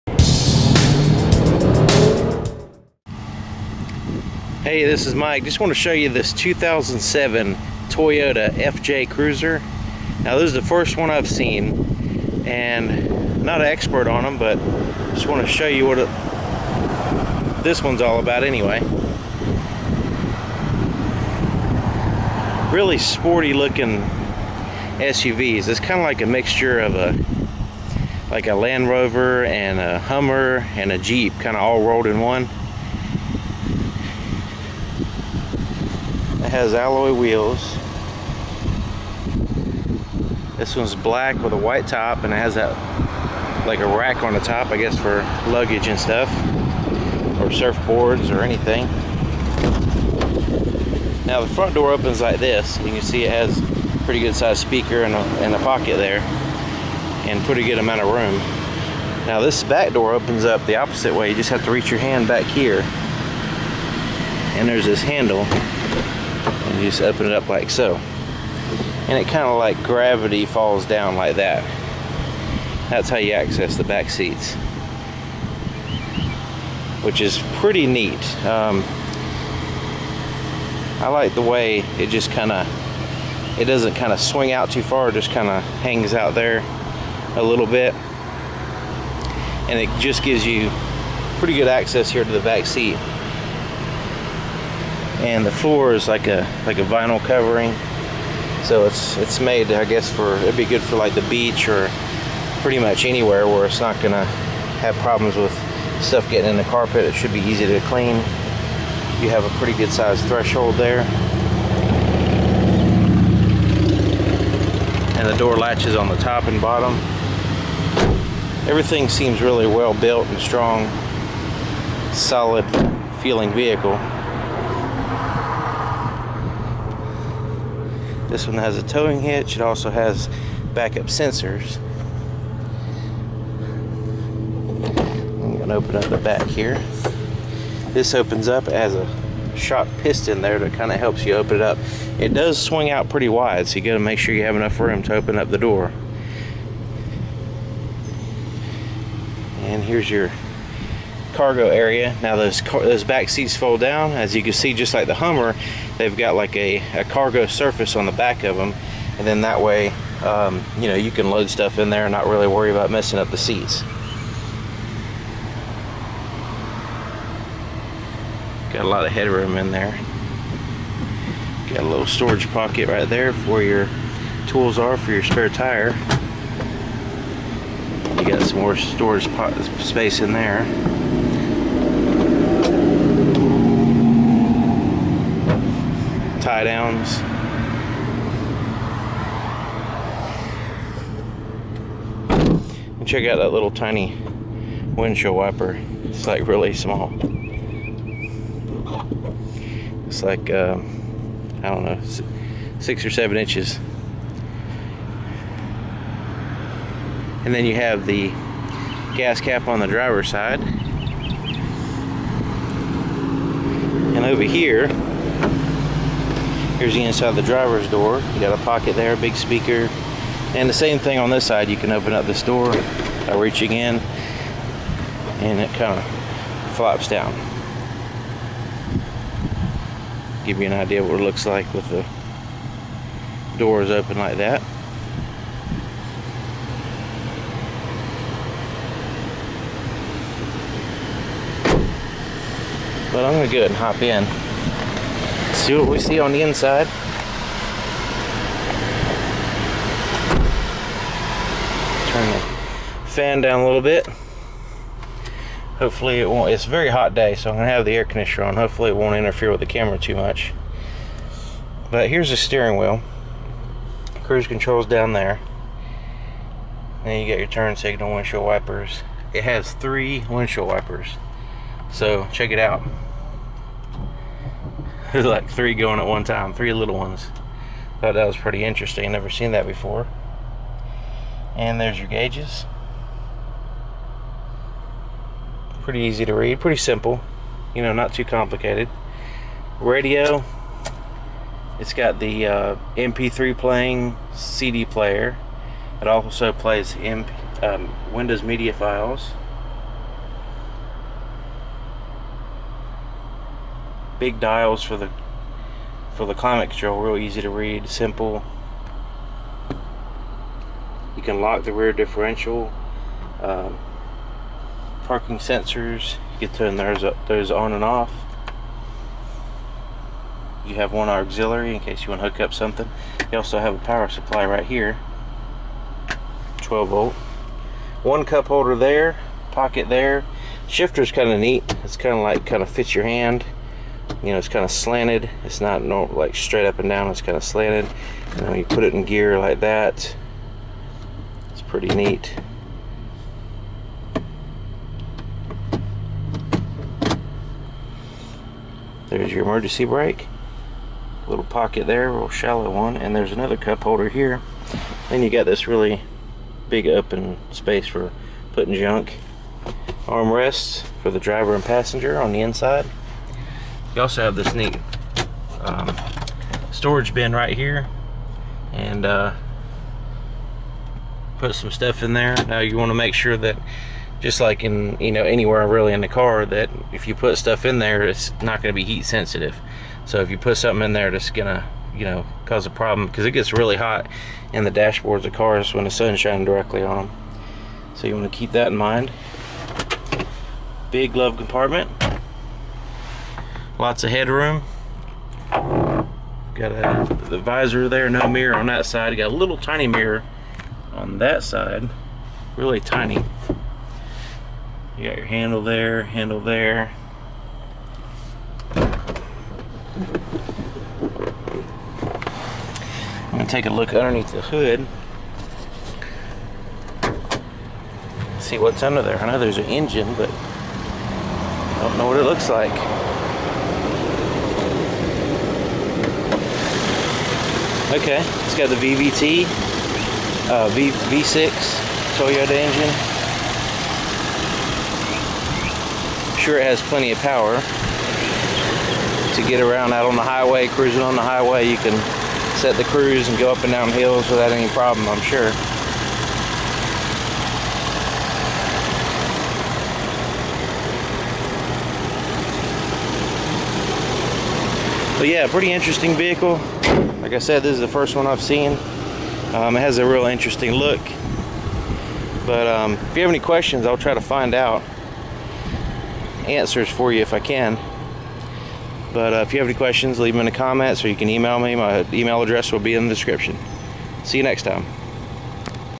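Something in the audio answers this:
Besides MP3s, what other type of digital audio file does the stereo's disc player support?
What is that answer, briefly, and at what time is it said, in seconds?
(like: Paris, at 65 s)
Windows Media files, at 298 s.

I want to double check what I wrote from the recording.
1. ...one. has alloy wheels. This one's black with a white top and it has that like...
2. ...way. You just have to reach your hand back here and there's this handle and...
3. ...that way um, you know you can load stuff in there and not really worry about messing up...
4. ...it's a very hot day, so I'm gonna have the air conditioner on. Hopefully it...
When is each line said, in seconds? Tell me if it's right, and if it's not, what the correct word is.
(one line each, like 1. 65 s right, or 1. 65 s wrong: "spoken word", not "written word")
1. 32 s right
2. 61 s right
3. 159 s right
4. 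256 s right.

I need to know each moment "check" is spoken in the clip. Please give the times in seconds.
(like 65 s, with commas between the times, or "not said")
193 s, 272 s.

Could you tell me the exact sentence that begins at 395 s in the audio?
Got a, the visor there, no mirror on that side.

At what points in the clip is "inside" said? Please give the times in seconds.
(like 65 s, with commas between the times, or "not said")
217 s, 246 s, 362 s.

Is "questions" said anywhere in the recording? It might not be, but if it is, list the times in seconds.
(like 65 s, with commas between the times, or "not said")
463 s, 469 s.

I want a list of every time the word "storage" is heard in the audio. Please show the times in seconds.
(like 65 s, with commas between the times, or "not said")
172 s, 178 s, 366 s.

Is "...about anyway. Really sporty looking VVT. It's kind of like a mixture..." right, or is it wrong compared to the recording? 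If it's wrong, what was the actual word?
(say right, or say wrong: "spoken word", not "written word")
wrong: "SUVs", not "VVT".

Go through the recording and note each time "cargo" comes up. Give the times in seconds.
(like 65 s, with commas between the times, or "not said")
151 s, 157 s.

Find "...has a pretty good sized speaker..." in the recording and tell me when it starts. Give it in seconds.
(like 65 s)
53 s.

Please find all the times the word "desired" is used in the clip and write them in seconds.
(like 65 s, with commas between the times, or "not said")
not said.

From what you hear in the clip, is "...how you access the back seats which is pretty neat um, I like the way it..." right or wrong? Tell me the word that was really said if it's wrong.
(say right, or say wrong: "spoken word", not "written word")
right.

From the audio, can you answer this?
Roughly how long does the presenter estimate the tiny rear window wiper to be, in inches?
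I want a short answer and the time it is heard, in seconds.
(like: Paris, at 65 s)
6 or 7 inches, at 202 s.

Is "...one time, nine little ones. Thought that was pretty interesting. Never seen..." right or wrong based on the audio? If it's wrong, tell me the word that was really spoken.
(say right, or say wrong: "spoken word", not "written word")
wrong: "three", not "nine".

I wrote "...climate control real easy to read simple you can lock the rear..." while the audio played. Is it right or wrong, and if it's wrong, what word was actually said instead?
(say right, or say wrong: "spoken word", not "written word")
right.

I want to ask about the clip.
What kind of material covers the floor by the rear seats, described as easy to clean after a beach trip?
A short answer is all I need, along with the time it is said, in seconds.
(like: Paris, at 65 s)
Vinyl, at 96 s.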